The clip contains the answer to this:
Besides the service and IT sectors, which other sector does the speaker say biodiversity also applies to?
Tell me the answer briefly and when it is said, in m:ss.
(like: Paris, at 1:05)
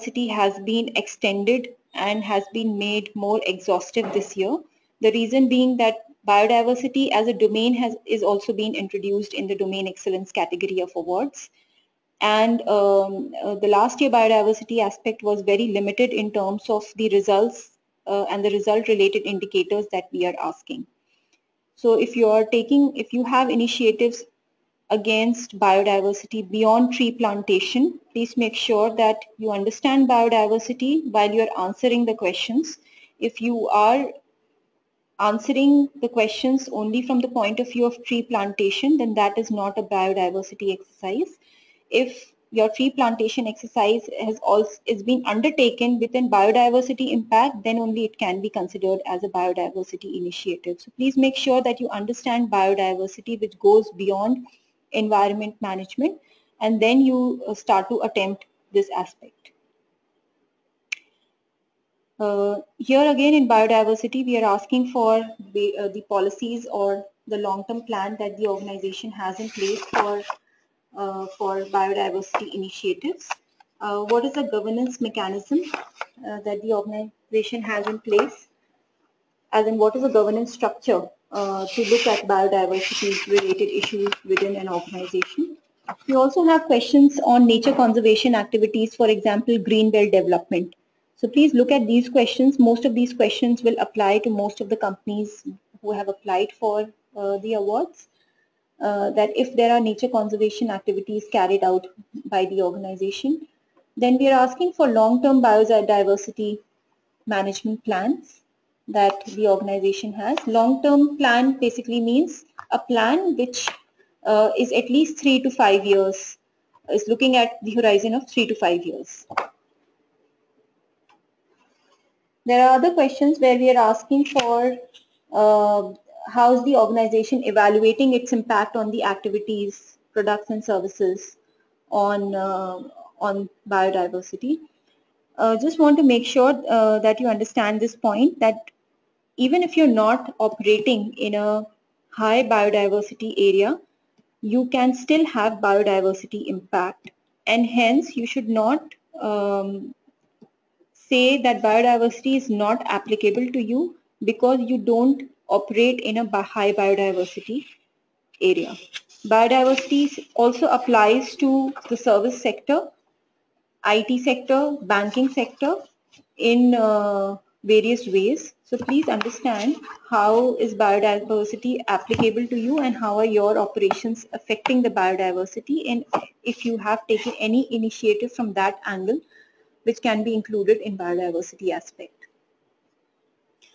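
Banking sector, at 2:44.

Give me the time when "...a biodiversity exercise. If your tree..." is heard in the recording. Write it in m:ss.
0:39.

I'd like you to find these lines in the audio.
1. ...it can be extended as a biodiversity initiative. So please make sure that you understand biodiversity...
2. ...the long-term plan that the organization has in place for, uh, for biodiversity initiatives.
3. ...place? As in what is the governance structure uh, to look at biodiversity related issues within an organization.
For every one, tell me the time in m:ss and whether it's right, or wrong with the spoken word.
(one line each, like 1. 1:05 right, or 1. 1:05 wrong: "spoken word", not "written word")
1. 0:48 wrong: "considered", not "extended"
2. 1:07 right
3. 1:17 right.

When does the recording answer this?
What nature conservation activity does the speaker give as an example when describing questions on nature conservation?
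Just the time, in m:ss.
1:29.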